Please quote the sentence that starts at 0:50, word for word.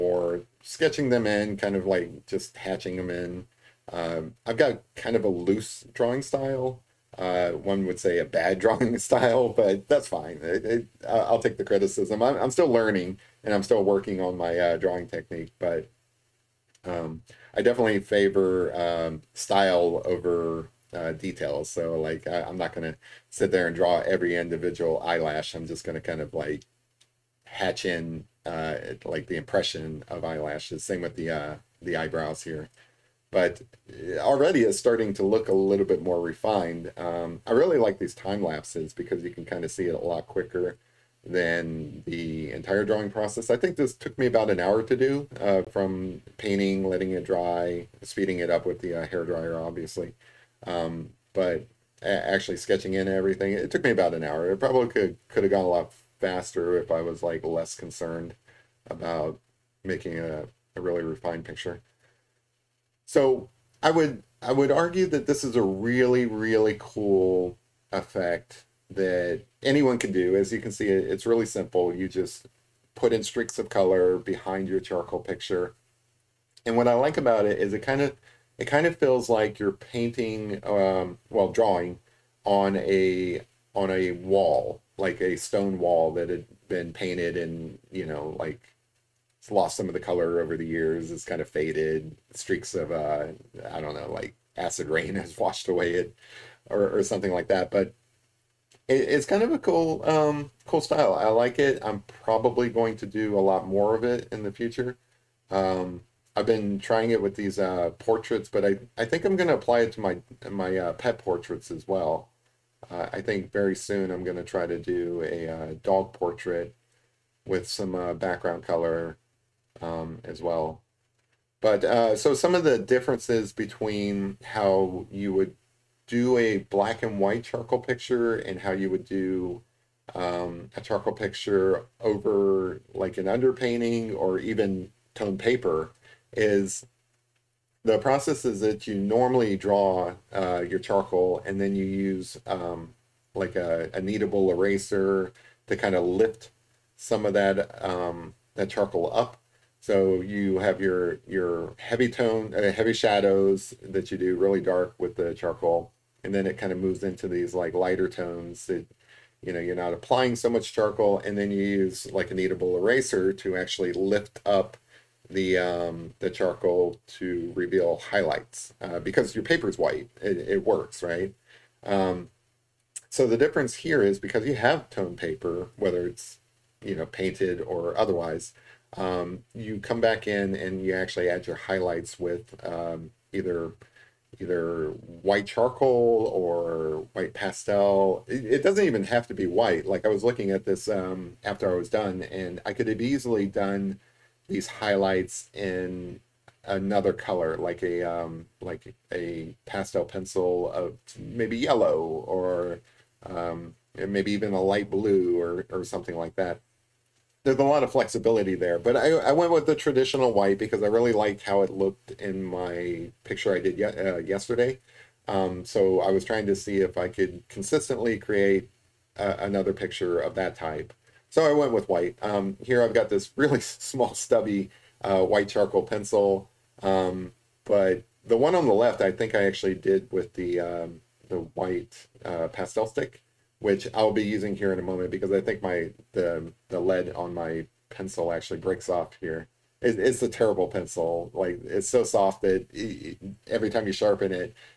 Um, but actually sketching in everything, it took me about an hour.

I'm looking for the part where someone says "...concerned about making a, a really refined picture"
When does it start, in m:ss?
0:57.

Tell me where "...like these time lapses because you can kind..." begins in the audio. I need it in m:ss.
0:37.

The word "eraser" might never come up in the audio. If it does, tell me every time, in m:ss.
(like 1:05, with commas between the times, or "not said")
2:24, 2:42.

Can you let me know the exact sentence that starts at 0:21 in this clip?
So like I, am not gonna sit there and draw every individual eyelash.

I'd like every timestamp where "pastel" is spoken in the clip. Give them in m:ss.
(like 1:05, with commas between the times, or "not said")
3:07, 3:19, 3:52.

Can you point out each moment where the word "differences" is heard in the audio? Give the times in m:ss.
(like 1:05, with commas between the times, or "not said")
2:02, 2:53.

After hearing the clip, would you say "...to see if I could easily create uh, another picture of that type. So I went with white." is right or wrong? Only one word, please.
wrong.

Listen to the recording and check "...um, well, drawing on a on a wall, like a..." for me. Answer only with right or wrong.
right.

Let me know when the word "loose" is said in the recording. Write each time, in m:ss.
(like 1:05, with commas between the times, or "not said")
0:05.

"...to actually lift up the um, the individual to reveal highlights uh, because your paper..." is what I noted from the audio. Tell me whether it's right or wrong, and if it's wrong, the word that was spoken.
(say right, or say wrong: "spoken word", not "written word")
wrong: "charcoal", not "individual".